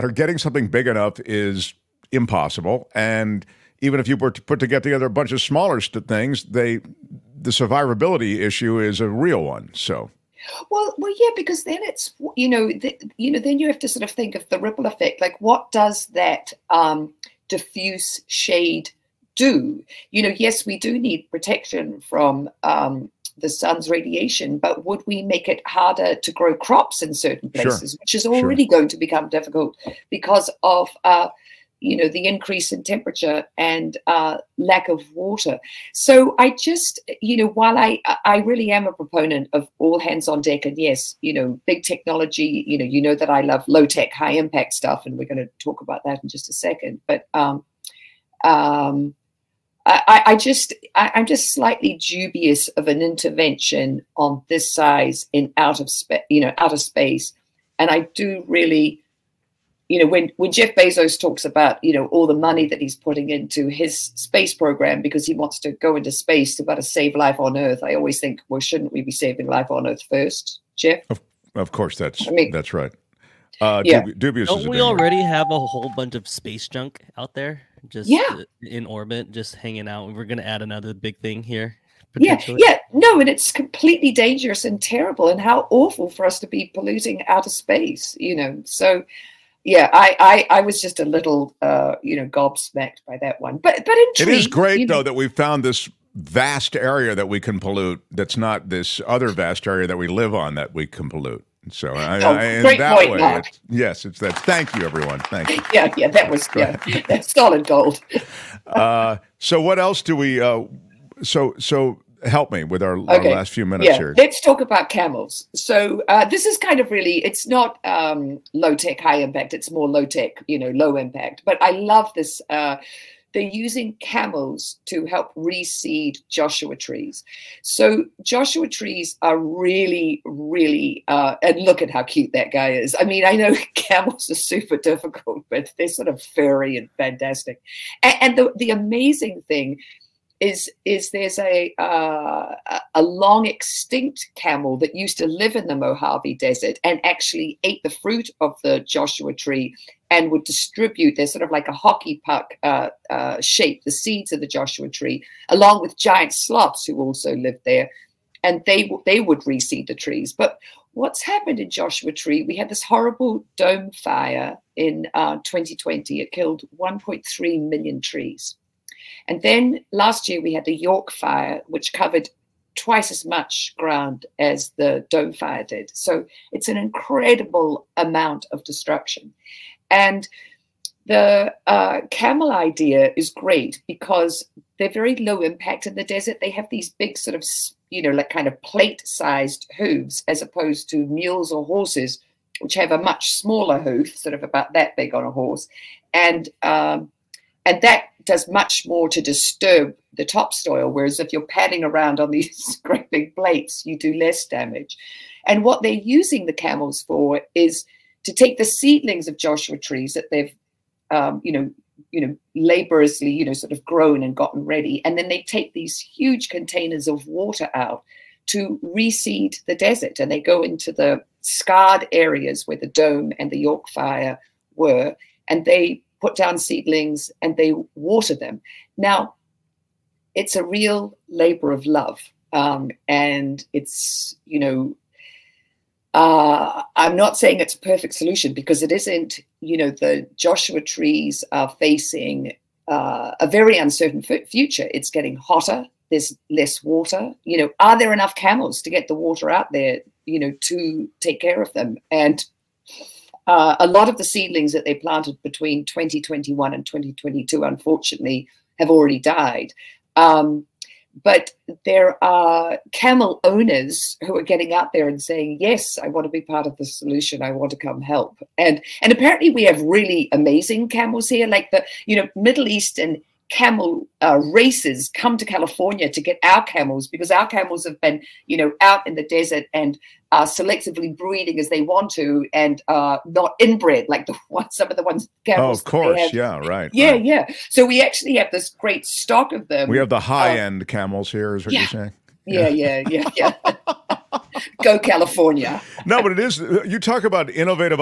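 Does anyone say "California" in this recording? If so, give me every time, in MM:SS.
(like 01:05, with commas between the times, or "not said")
04:35, 04:54.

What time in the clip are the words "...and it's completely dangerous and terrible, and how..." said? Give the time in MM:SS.
01:23.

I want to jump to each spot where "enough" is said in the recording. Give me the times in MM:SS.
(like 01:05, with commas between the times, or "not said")
00:00, 04:08.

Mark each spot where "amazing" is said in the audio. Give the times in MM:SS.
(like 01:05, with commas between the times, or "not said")
02:18, 04:30.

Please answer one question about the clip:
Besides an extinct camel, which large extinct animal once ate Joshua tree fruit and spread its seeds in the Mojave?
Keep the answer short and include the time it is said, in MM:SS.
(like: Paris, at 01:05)
giant sloths, at 02:35.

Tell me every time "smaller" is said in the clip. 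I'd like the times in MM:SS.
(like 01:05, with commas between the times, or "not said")
00:05, 03:13.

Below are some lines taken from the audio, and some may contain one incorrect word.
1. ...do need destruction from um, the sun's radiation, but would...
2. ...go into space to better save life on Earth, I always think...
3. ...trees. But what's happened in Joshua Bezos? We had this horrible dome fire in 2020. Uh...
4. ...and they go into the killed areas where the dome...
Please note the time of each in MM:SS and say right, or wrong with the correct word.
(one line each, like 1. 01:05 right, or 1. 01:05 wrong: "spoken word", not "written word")
1. 00:20 wrong: "protection", not "destruction"
2. 01:05 right
3. 02:39 wrong: "Tree", not "Bezos"
4. 03:40 wrong: "scarred", not "killed".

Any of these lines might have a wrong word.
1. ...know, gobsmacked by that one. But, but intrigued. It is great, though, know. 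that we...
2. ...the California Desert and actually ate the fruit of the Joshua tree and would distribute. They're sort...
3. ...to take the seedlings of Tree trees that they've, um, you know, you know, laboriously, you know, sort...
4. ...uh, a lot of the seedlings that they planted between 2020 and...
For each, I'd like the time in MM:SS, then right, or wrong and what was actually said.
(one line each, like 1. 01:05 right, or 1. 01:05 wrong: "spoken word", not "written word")
1. 01:32 right
2. 02:25 wrong: "Mojave", not "California"
3. 03:28 wrong: "Joshua", not "Tree"
4. 04:13 wrong: "2021", not "2020".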